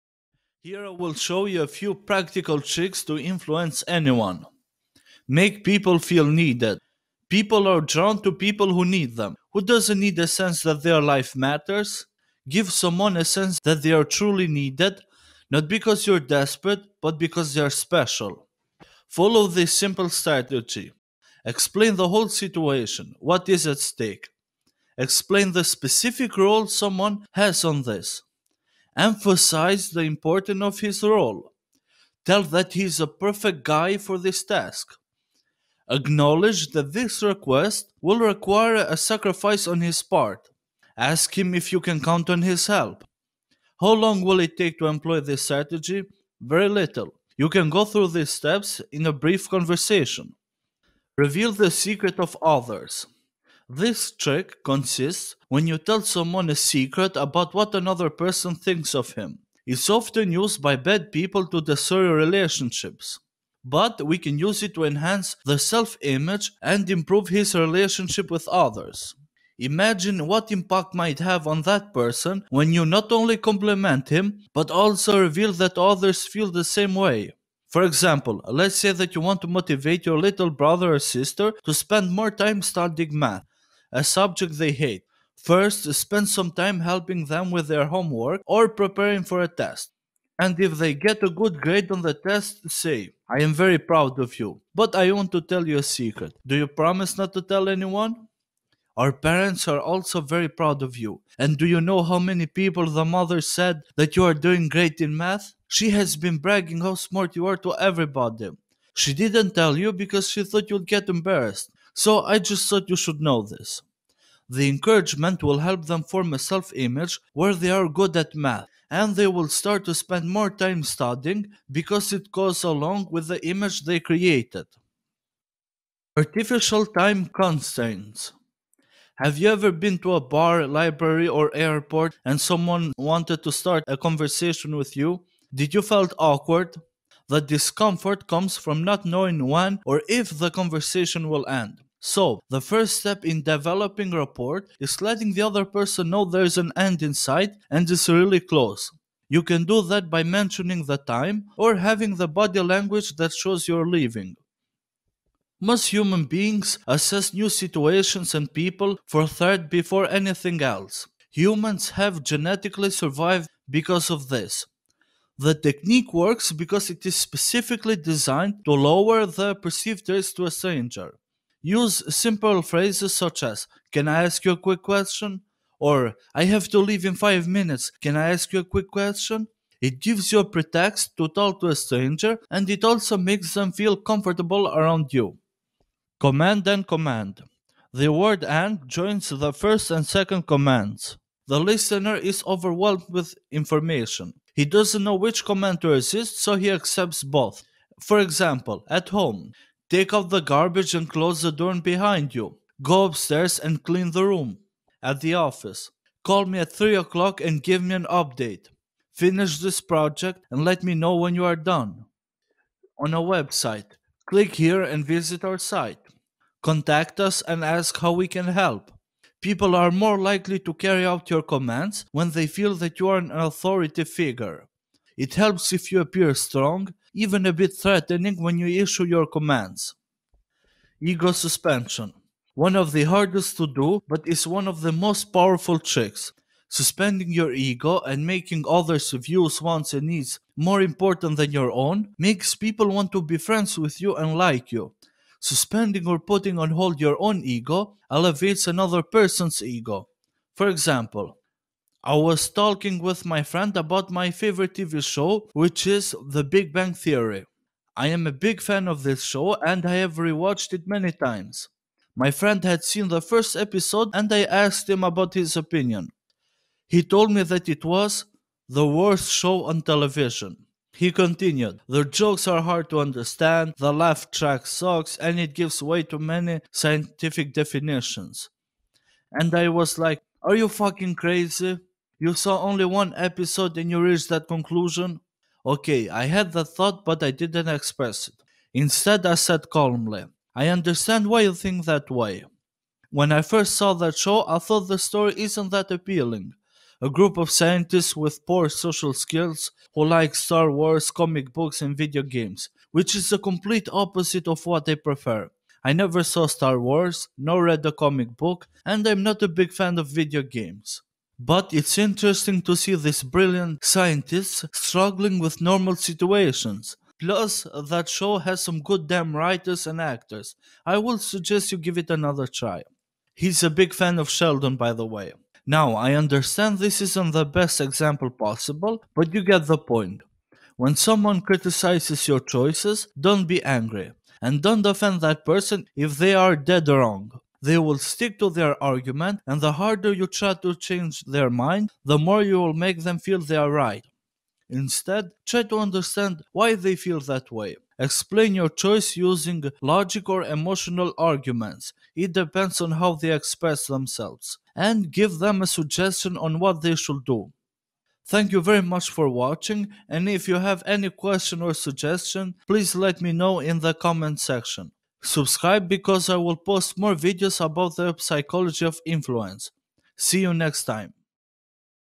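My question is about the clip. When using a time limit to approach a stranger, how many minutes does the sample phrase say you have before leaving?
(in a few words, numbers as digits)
5.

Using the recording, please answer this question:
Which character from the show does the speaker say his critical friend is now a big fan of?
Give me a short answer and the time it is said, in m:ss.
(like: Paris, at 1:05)
Sheldon, at 5:24.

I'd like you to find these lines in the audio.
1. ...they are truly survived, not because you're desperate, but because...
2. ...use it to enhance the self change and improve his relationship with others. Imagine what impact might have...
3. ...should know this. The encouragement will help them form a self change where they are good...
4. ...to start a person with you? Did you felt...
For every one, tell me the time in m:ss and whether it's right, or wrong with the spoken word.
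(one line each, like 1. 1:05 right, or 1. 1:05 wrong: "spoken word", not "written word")
1. 0:13 wrong: "needed", not "survived"
2. 1:04 wrong: "image", not "change"
3. 1:52 wrong: "image", not "change"
4. 2:13 wrong: "conversation", not "person".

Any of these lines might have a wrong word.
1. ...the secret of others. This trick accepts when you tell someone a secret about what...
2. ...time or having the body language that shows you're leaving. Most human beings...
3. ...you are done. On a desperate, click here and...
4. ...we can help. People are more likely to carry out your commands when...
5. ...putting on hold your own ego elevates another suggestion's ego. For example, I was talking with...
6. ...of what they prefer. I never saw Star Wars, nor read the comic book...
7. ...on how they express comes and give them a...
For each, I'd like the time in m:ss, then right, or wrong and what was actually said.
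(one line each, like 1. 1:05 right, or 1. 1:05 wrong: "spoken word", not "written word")
1. 0:51 wrong: "consists", not "accepts"
2. 2:30 right
3. 3:31 wrong: "website", not "desperate"
4. 3:38 right
5. 4:06 wrong: "person", not "suggestion"
6. 5:04 right
7. 5:52 wrong: "themselves", not "comes".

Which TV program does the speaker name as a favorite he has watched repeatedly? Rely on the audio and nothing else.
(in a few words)
The Big Bang Theory.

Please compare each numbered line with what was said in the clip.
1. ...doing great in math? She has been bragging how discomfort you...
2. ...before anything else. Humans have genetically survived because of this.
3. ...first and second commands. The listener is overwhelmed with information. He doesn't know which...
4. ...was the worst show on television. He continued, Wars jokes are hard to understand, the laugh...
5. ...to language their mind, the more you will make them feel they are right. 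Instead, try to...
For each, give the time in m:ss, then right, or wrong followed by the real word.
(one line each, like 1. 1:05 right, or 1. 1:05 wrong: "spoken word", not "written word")
1. 1:44 wrong: "smart", not "discomfort"
2. 2:39 right
3. 3:09 right
4. 4:27 wrong: "The", not "Wars"
5. 5:40 wrong: "change", not "language".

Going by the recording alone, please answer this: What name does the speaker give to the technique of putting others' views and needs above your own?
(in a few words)
Ego suspension.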